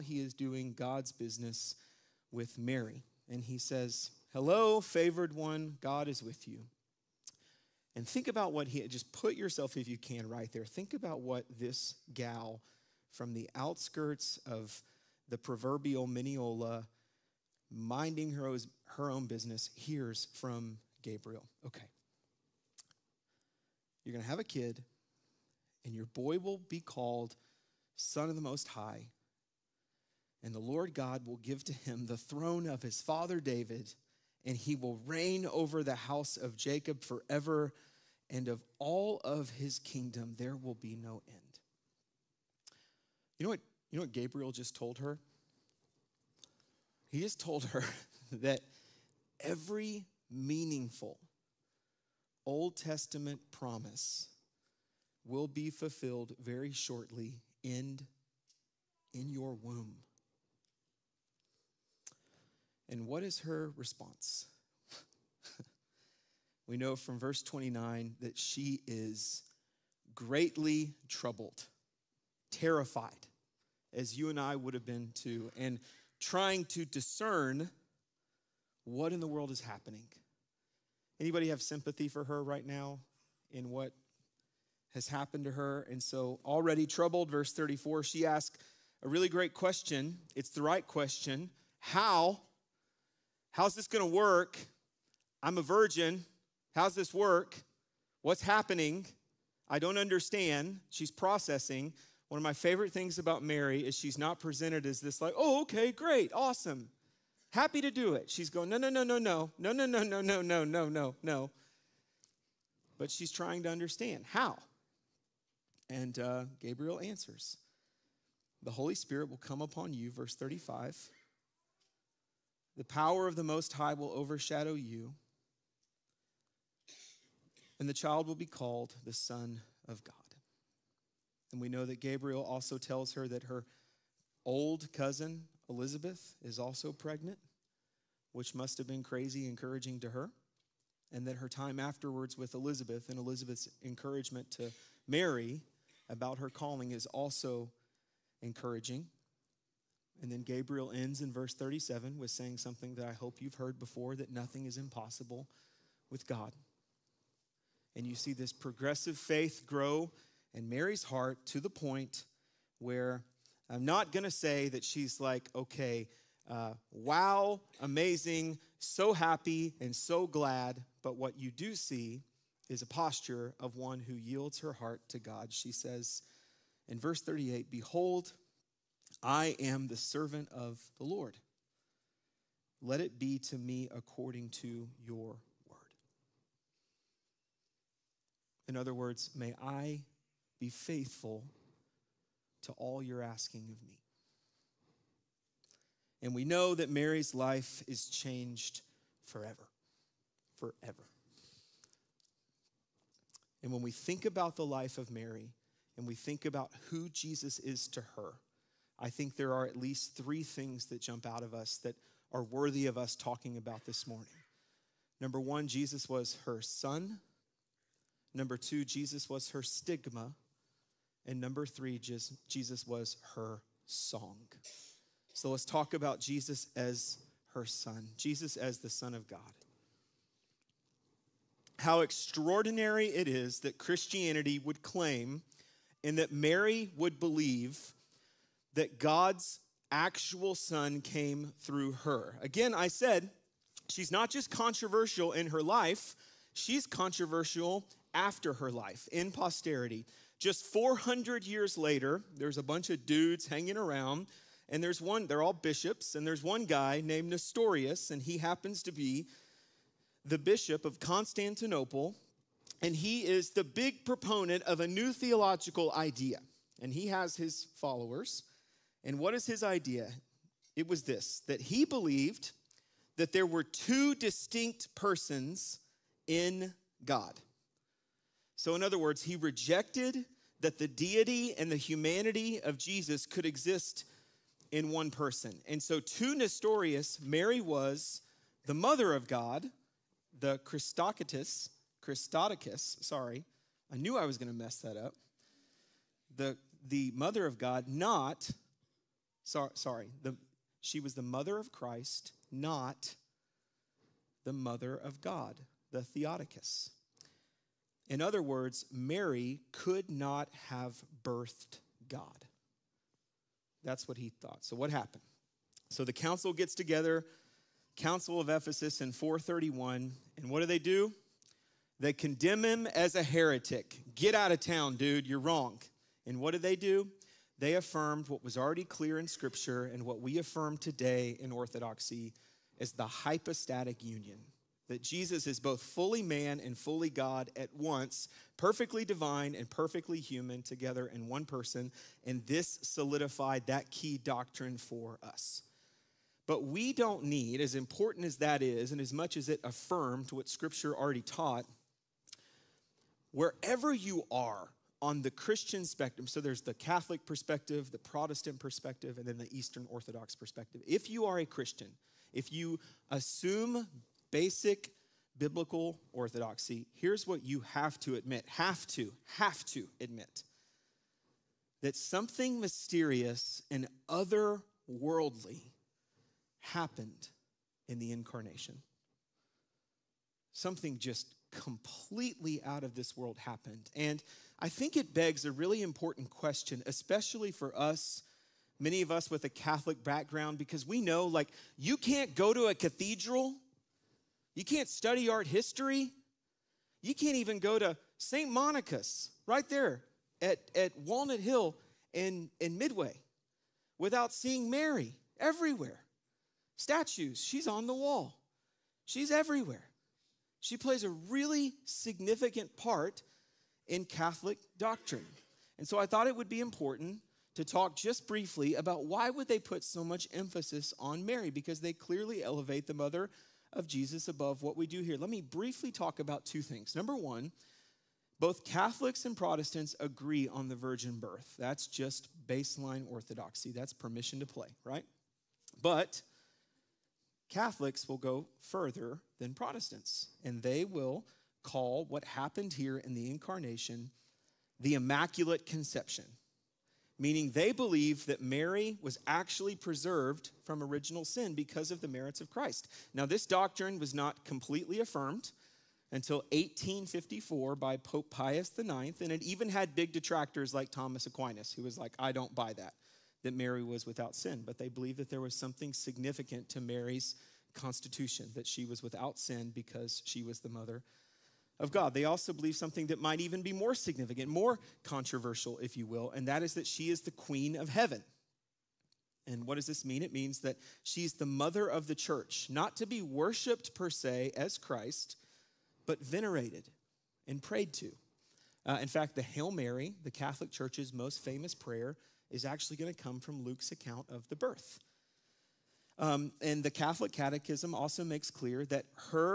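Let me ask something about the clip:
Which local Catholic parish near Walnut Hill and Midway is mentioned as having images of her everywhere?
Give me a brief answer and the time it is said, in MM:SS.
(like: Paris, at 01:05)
St. Monica's, at 06:38.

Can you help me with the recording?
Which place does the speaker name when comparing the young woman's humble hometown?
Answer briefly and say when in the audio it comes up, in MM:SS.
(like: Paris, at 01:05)
Mineola, at 00:16.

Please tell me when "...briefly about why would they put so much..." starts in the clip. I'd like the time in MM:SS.
06:58.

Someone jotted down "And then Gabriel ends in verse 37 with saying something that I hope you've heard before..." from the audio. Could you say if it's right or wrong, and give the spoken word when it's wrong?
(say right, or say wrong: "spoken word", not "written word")
right.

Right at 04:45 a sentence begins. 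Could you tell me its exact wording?
And so to Nestorius, Mary was the mother of God, the Christocratus, Christotokos, sorry.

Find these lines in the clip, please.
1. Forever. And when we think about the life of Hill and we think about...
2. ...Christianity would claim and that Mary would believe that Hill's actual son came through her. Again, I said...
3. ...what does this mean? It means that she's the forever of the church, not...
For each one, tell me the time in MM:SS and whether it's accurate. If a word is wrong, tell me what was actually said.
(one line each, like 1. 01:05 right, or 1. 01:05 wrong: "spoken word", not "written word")
1. 03:20 wrong: "Mary", not "Hill"
2. 03:53 wrong: "God", not "Hill"
3. 07:59 wrong: "mother", not "forever".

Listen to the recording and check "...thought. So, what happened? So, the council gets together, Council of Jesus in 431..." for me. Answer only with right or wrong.
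wrong.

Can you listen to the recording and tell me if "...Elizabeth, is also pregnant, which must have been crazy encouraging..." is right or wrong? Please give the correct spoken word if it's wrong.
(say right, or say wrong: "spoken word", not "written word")
right.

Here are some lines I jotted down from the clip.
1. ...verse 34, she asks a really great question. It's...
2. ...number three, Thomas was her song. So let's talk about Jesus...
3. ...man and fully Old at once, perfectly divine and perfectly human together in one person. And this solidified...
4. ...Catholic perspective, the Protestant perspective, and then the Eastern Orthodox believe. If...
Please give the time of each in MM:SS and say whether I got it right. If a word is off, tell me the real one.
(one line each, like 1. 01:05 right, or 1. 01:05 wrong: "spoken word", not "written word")
1. 01:27 right
2. 03:41 wrong: "Jesus", not "Thomas"
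3. 05:36 wrong: "God", not "Old"
4. 05:56 wrong: "perspective", not "believe".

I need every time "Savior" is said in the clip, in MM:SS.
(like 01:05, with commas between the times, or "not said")
not said.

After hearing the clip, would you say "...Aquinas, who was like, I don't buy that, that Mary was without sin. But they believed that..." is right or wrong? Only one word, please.
right.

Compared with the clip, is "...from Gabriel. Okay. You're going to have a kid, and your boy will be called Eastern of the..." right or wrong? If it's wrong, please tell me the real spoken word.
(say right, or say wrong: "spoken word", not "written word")
wrong: "Son", not "Eastern".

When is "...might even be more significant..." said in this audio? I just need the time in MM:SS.
07:53.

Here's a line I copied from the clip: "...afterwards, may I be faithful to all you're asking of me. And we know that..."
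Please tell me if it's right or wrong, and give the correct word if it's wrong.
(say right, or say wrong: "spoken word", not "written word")
wrong: "words", not "afterwards".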